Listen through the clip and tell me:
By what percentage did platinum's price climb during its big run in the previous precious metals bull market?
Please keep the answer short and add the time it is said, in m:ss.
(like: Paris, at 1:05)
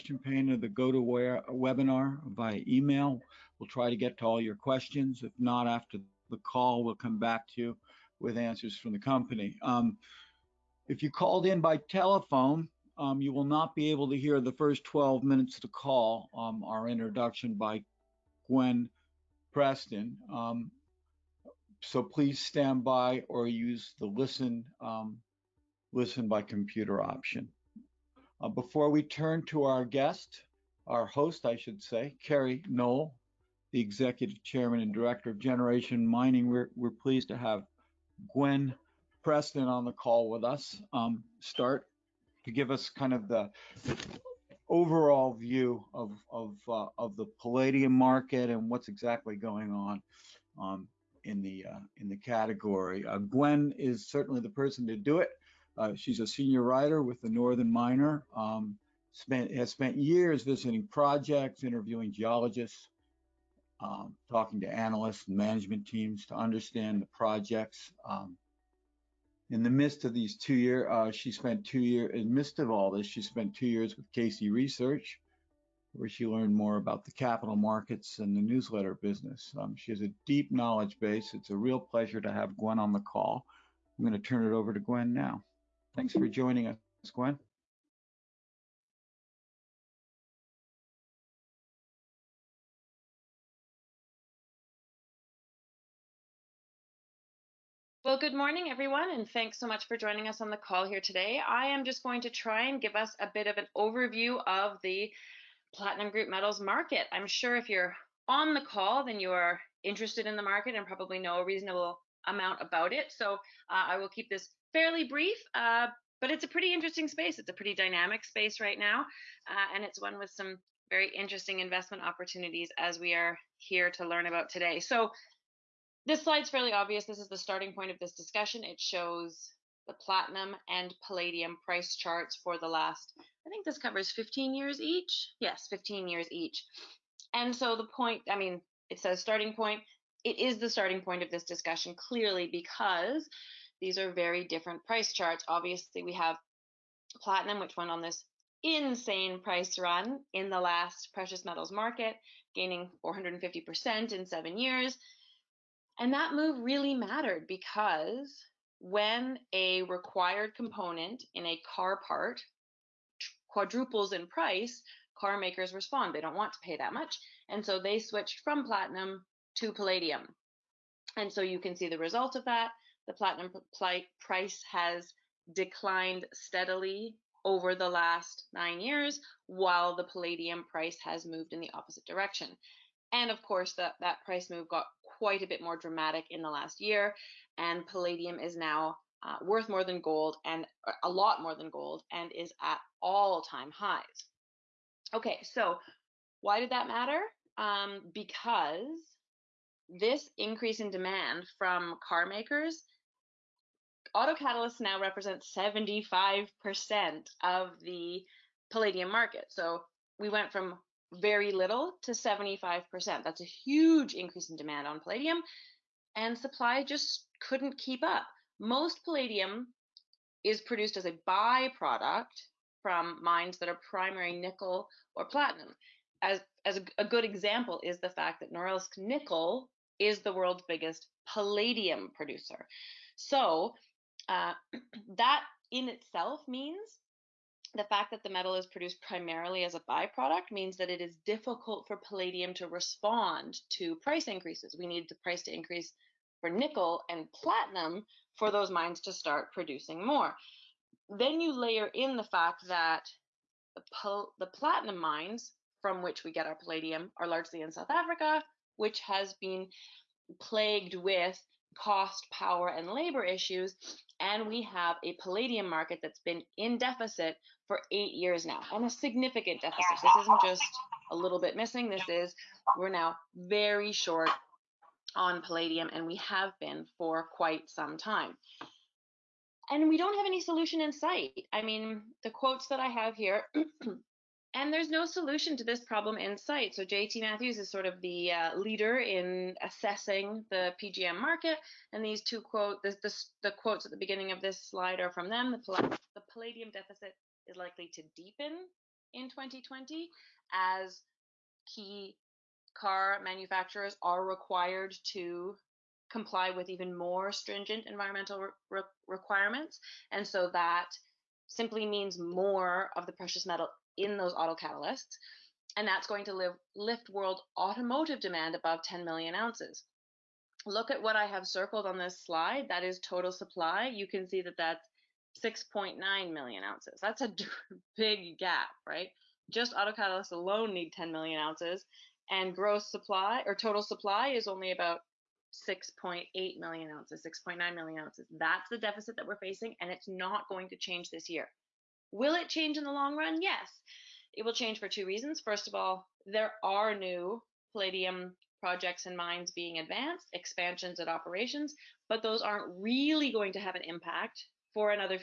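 450%, at 2:33.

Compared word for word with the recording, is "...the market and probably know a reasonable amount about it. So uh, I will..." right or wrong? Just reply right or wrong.
right.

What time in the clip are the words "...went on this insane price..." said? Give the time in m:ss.
2:27.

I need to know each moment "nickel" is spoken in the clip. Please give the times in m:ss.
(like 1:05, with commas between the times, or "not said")
3:44, 3:48, 4:06.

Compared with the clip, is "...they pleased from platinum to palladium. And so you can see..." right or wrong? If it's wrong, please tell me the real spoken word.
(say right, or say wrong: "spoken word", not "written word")
wrong: "switched", not "pleased".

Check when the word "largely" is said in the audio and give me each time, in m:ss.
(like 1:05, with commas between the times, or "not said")
4:17.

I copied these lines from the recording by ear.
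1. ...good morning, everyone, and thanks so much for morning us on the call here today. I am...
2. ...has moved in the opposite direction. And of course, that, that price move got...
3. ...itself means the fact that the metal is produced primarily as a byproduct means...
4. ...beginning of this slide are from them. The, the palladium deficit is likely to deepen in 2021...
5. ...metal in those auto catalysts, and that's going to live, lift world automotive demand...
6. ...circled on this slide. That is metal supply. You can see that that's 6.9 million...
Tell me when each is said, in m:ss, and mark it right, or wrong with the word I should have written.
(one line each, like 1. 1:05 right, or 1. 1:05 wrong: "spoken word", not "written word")
1. 1:38 wrong: "joining", not "morning"
2. 3:01 right
3. 3:55 right
4. 4:53 wrong: "2020", not "2021"
5. 5:13 right
6. 5:21 wrong: "total", not "metal".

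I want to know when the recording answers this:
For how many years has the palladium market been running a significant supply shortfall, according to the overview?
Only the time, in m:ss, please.
4:27.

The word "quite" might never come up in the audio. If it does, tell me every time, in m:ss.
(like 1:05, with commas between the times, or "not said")
3:05, 4:37.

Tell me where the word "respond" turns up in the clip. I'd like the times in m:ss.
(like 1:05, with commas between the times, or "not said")
2:45, 4:02.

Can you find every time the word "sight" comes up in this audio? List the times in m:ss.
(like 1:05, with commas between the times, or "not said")
4:40, 4:46.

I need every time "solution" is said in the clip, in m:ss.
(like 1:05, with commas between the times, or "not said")
4:40, 4:45.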